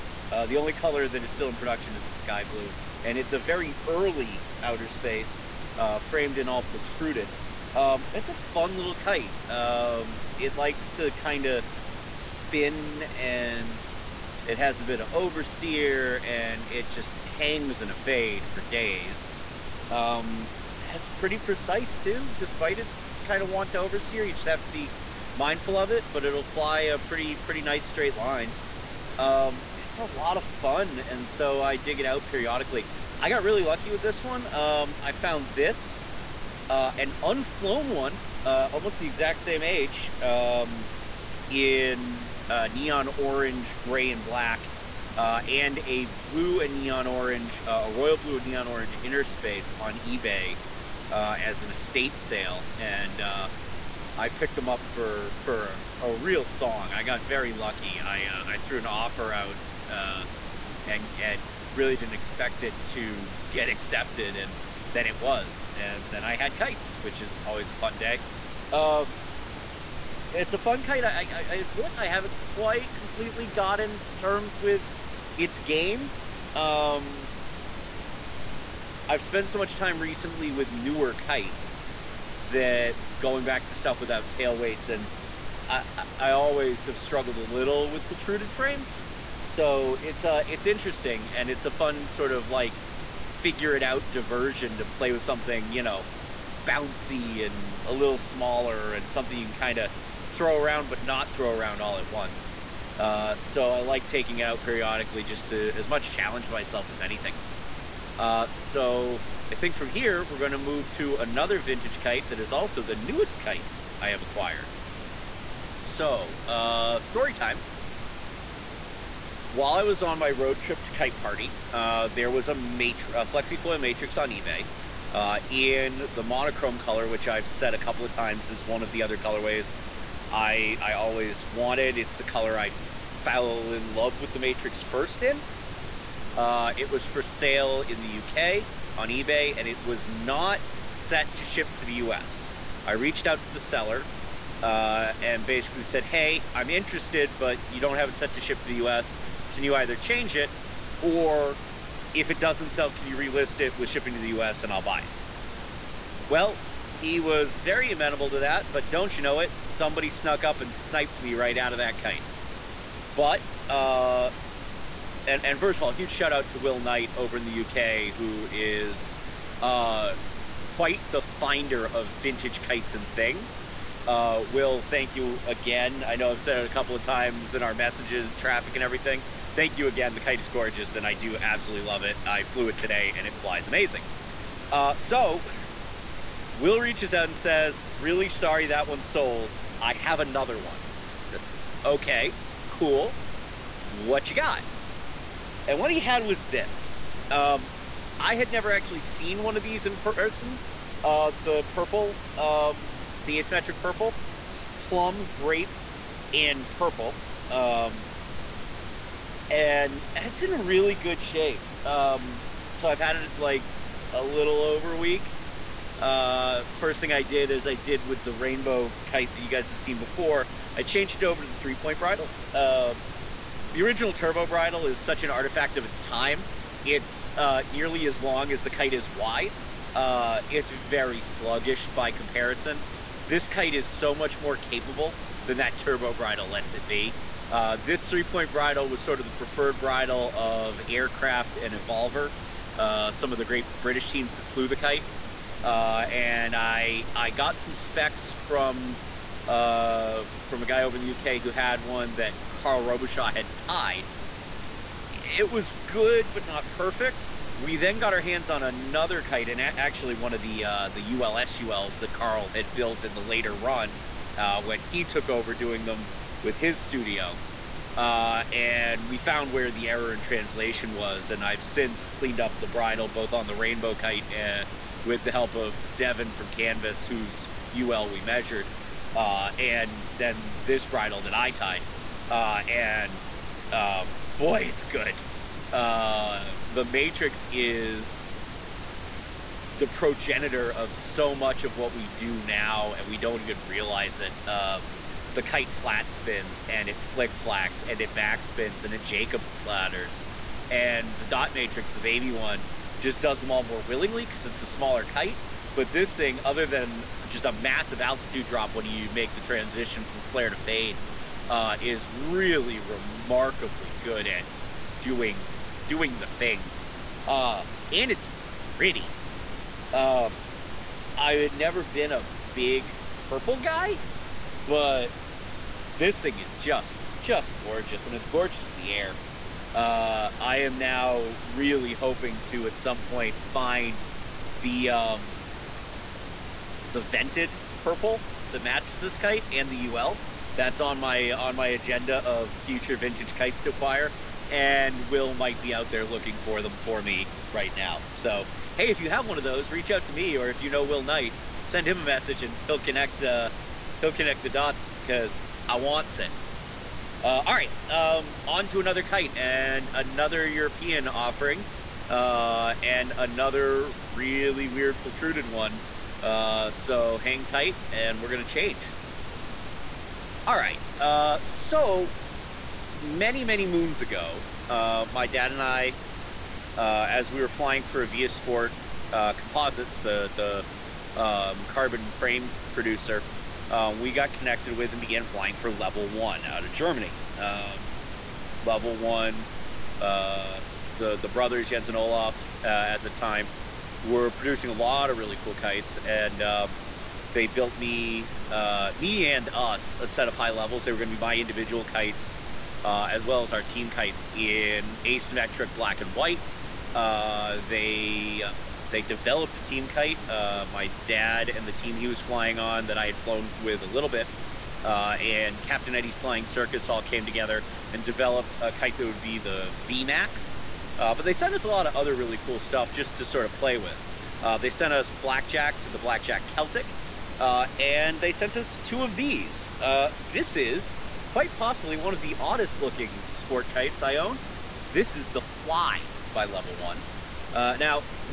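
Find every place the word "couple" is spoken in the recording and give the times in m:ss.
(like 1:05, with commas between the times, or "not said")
2:07, 2:56.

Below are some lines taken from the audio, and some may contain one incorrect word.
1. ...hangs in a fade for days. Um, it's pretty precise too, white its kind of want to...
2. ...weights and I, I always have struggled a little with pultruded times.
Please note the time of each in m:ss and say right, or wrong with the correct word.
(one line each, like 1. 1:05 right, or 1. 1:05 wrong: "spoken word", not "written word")
1. 0:17 wrong: "despite", not "white"
2. 1:24 wrong: "frames", not "times".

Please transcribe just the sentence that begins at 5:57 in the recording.
Uh, all right, um, on to another kite and another European offering, uh, and another really weird pultruded one.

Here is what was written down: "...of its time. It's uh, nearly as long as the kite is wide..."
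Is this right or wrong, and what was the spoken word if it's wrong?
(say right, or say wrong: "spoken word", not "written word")
right.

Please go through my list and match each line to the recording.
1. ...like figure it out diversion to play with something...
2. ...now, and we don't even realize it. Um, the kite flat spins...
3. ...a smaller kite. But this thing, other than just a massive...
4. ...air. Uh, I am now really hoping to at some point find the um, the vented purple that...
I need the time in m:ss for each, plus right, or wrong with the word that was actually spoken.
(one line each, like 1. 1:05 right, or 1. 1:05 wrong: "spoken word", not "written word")
1. 1:32 right
2. 4:52 right
3. 5:04 right
4. 5:28 right.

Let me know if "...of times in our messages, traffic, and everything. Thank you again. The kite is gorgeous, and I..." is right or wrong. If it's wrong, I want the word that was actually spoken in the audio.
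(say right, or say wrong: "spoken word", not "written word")
right.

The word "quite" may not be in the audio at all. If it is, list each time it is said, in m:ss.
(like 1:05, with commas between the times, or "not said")
1:12, 2:50, 7:11.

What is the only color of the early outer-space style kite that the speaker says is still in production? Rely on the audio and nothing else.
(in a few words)
sky blue.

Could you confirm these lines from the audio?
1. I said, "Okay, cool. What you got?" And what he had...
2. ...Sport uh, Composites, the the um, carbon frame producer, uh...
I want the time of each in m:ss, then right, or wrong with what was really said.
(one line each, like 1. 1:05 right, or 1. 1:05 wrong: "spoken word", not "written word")
1. 3:10 right
2. 6:18 right.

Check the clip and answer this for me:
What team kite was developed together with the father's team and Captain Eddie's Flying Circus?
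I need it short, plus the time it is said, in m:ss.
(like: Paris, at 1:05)
VMAX, at 6:59.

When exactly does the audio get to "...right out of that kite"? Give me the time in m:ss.
2:41.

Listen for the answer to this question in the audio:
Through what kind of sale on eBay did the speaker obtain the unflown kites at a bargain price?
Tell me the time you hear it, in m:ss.
0:51.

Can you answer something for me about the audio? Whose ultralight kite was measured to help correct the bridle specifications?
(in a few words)
Devin from Canvas.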